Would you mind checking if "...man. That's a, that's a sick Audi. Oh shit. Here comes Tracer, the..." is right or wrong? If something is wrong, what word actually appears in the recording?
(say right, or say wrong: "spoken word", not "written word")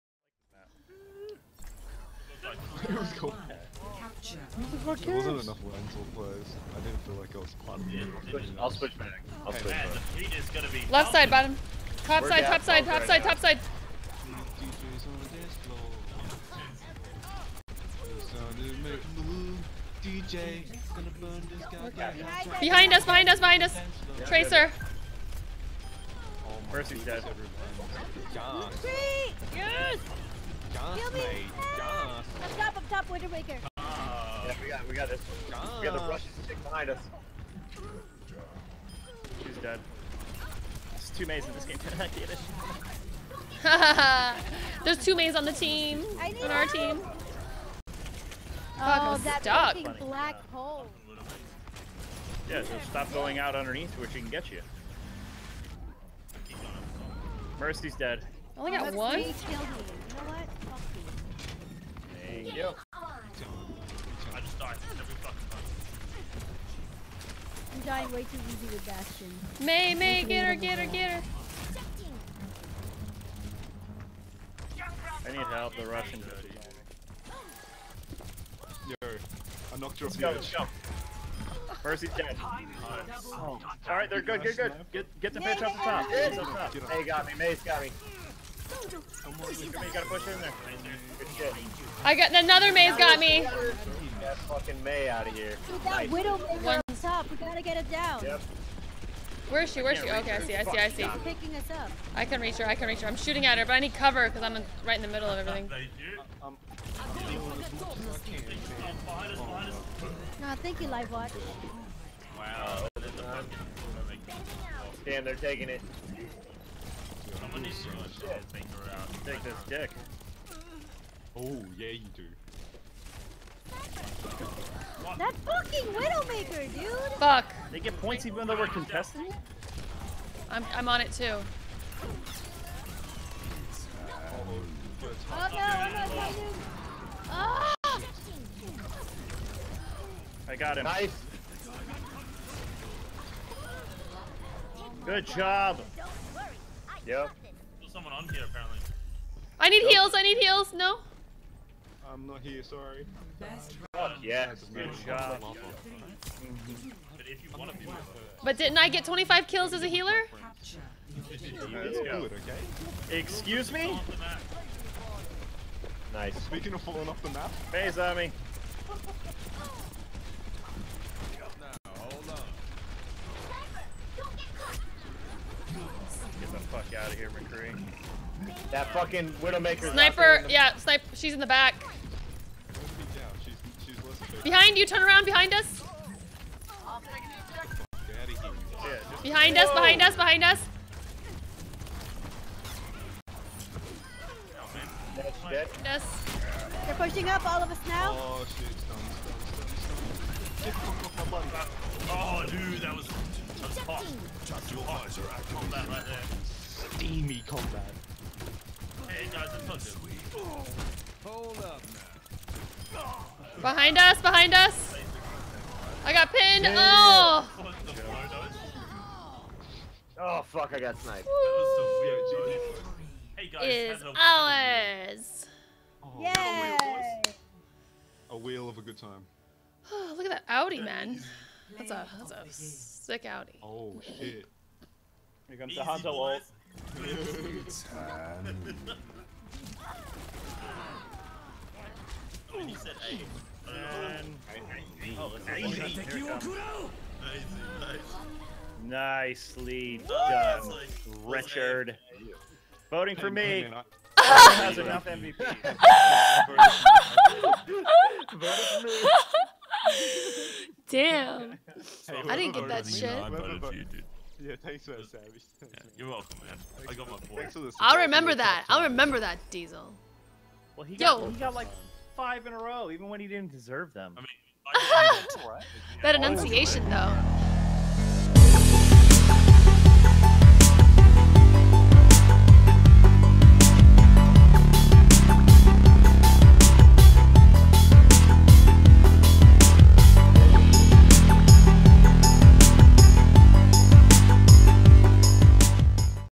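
wrong: "Easy", not "Tracer".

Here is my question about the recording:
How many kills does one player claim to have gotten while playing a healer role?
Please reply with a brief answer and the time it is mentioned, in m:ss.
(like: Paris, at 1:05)
25, at 2:39.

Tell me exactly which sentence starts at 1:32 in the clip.
I got another Mei's got me.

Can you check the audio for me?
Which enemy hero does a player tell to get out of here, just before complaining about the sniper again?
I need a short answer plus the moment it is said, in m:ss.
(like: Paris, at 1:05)
McCree, at 2:57.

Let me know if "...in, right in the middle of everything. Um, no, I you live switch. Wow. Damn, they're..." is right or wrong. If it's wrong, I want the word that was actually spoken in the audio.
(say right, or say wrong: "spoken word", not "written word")
wrong: "watch", not "switch".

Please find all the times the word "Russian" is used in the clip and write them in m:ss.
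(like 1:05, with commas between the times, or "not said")
0:36, 1:15.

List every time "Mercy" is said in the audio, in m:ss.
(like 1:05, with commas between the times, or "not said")
0:26, 0:57, 1:21.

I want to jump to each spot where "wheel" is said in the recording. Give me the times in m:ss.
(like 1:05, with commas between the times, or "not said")
3:48.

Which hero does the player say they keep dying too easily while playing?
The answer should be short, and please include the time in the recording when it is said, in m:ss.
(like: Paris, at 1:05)
Bastion, at 1:08.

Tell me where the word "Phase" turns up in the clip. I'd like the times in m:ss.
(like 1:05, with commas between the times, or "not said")
2:47.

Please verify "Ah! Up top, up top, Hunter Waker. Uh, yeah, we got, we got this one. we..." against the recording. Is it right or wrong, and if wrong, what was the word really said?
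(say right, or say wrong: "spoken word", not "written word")
wrong: "Winter", not "Hunter".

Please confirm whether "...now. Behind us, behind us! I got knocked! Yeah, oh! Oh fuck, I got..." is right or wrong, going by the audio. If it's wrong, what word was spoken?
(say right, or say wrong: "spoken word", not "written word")
wrong: "pinned", not "knocked".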